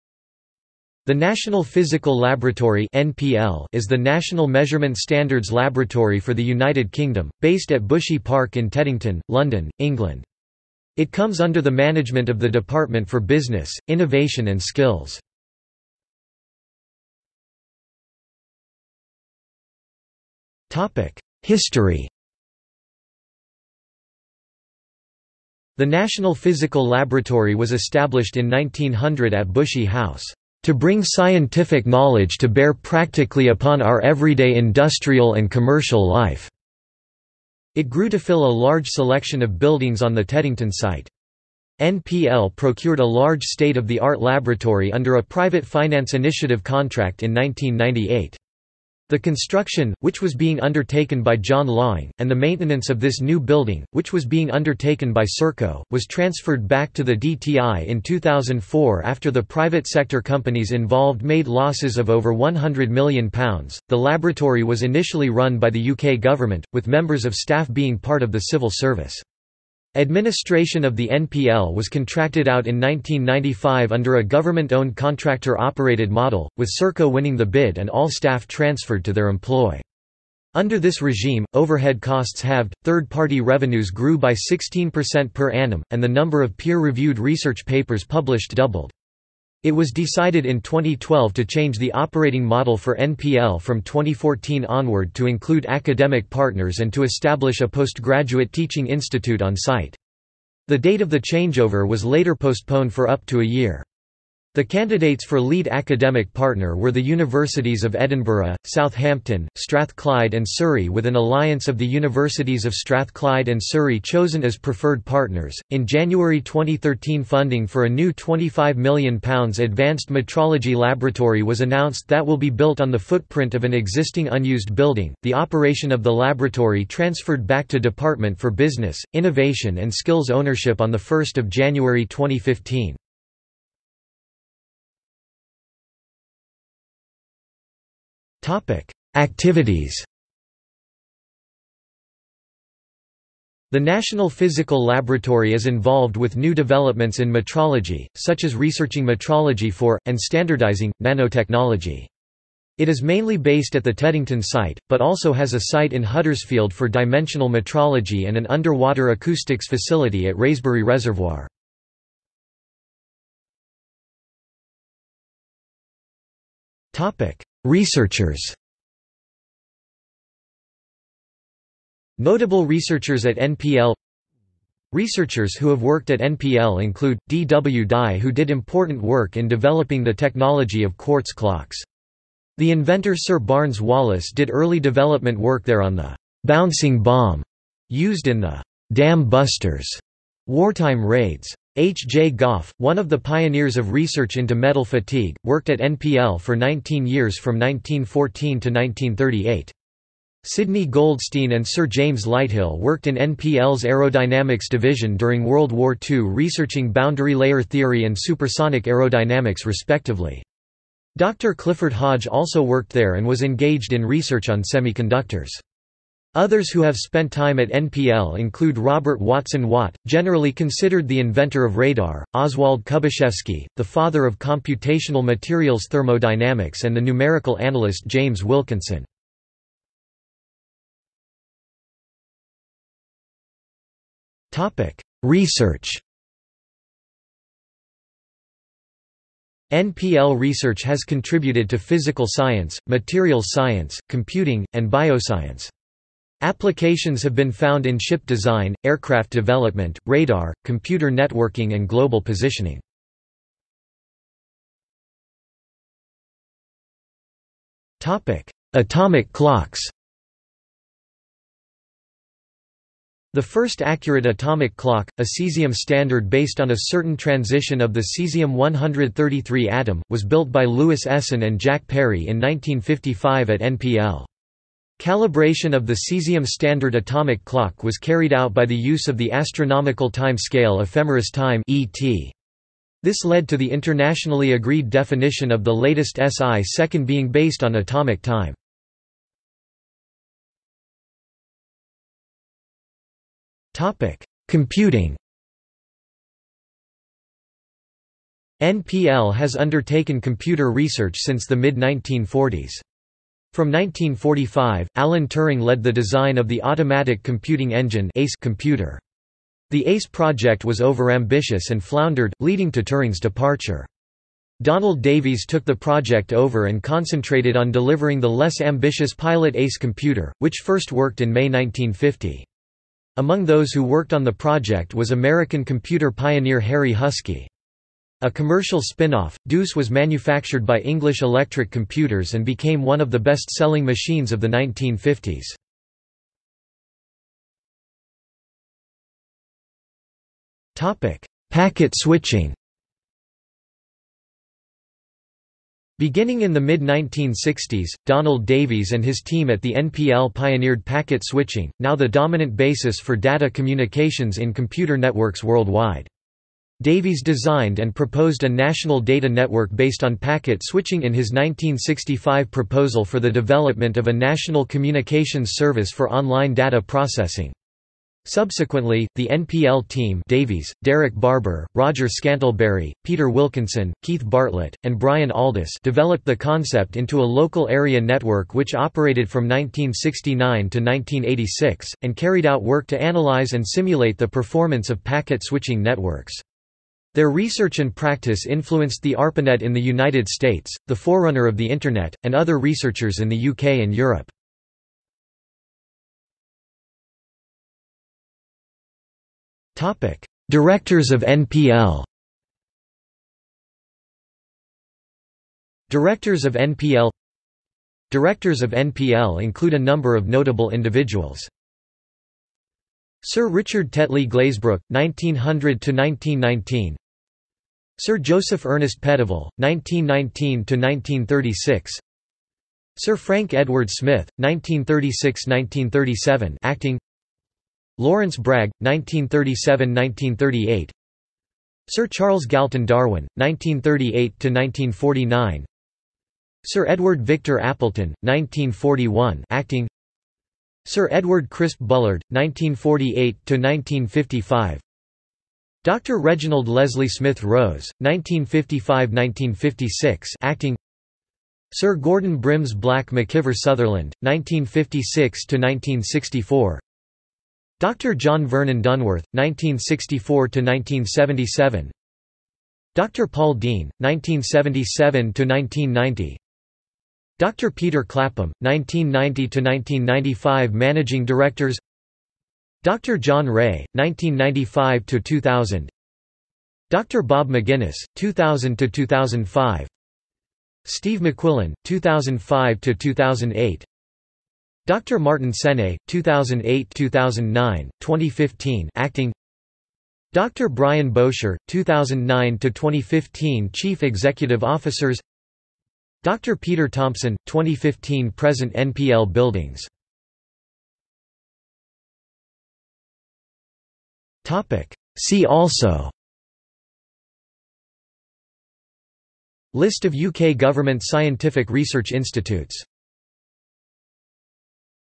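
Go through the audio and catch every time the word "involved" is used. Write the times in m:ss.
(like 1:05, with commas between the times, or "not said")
1:00, 2:25.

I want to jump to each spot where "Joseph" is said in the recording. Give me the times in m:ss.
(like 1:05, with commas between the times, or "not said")
6:58.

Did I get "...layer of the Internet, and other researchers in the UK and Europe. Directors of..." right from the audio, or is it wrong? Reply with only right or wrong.
wrong.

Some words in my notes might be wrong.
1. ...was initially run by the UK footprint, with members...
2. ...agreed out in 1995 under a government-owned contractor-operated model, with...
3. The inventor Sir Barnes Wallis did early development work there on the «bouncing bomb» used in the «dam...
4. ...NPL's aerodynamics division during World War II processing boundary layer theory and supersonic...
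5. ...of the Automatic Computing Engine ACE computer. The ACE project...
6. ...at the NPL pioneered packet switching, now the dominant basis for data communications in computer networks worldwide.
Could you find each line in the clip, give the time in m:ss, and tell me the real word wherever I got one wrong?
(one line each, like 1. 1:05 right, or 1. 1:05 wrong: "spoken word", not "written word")
1. 1:04 wrong: "government", not "footprint"
2. 1:11 wrong: "contracted", not "agreed"
3. 3:02 right
4. 3:23 wrong: "researching", not "processing"
5. 5:06 right
6. 5:49 right.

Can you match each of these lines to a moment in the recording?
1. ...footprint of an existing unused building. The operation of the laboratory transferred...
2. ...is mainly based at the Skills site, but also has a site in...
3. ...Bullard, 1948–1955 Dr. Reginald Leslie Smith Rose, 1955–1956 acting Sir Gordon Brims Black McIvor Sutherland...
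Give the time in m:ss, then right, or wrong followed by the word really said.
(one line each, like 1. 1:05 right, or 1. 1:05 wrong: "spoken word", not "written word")
1. 2:02 right
2. 2:32 wrong: "Teddington", not "Skills"
3. 7:21 right.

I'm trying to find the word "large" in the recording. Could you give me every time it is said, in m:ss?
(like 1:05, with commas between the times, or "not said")
0:38, 0:43.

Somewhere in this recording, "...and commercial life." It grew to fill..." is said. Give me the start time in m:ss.
0:35.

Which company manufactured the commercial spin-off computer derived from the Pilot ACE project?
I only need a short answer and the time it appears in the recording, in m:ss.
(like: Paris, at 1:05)
English Electric Computers, at 5:30.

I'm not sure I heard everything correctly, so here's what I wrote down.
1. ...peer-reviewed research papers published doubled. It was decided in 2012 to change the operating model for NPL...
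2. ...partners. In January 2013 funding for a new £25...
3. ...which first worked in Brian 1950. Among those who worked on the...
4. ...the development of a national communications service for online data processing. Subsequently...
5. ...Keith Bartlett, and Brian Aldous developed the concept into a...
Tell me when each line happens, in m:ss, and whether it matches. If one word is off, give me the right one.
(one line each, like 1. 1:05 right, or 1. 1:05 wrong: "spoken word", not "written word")
1. 1:26 right
2. 1:55 right
3. 5:20 wrong: "May", not "Brian"
4. 6:03 right
5. 6:14 right.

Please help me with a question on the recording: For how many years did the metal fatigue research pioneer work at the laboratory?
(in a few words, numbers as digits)
19.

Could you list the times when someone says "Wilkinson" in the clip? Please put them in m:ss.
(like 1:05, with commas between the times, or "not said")
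3:48, 6:13.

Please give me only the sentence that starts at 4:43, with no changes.
This led to the internationally agreed definition of the latest SI second being based on atomic time.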